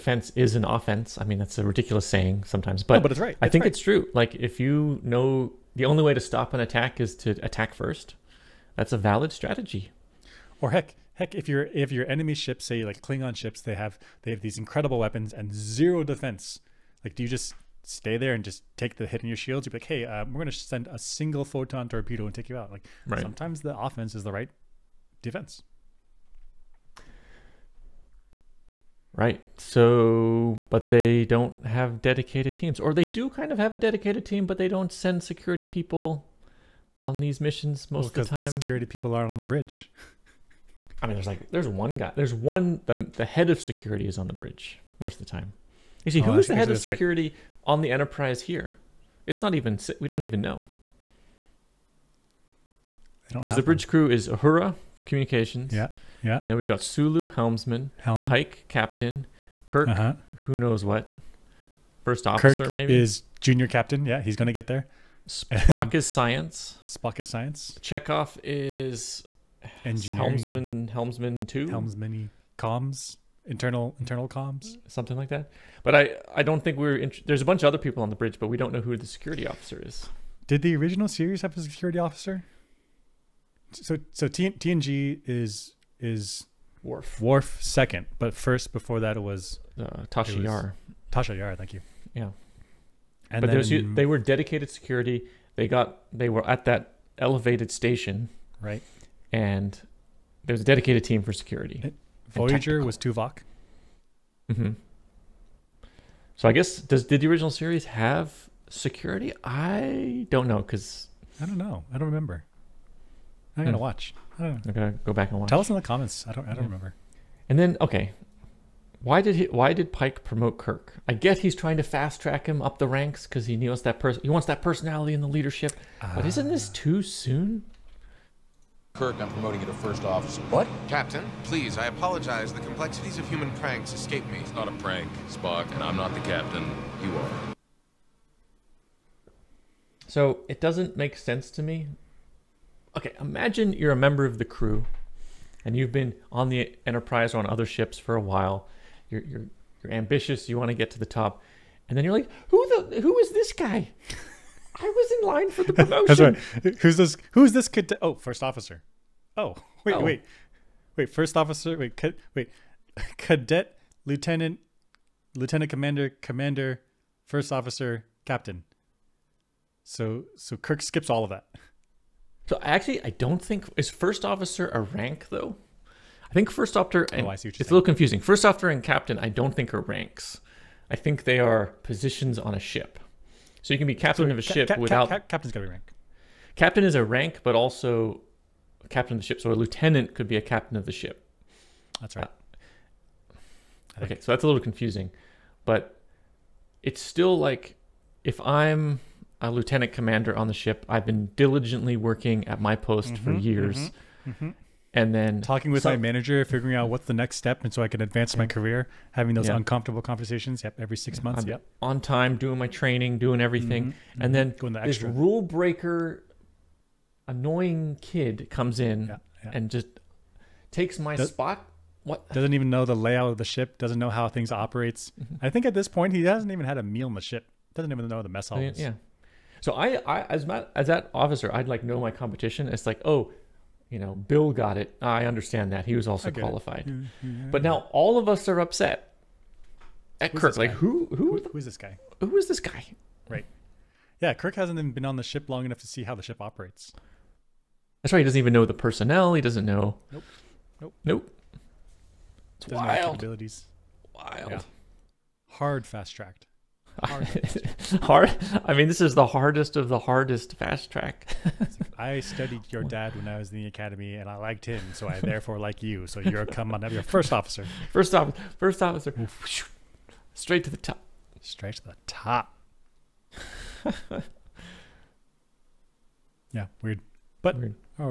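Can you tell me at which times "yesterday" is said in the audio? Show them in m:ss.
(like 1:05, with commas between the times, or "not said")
not said.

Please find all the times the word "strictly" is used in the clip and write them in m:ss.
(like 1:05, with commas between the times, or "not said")
not said.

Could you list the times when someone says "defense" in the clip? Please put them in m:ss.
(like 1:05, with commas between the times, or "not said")
0:16, 0:25.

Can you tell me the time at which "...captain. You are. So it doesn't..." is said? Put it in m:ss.
2:16.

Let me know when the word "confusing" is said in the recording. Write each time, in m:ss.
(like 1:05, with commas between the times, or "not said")
2:57, 3:14.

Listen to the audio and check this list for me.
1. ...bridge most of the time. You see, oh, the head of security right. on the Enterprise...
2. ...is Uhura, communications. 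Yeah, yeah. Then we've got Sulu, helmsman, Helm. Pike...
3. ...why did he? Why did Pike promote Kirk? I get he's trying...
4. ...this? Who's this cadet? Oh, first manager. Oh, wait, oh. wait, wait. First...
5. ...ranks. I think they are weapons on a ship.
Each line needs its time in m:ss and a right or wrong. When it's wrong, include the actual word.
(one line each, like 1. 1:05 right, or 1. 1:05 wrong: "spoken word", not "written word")
1. 0:44 right
2. 0:54 right
3. 1:59 right
4. 2:36 wrong: "officer", not "manager"
5. 2:59 wrong: "positions", not "weapons".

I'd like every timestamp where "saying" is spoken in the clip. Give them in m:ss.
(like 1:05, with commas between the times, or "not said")
0:02, 2:57.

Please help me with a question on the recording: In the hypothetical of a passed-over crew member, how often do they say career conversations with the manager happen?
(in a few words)
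Every 6 months.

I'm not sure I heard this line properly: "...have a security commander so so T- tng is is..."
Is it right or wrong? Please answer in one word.
wrong.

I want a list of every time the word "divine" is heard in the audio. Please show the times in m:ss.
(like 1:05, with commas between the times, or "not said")
not said.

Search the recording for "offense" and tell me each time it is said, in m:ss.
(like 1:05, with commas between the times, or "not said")
0:00, 0:23.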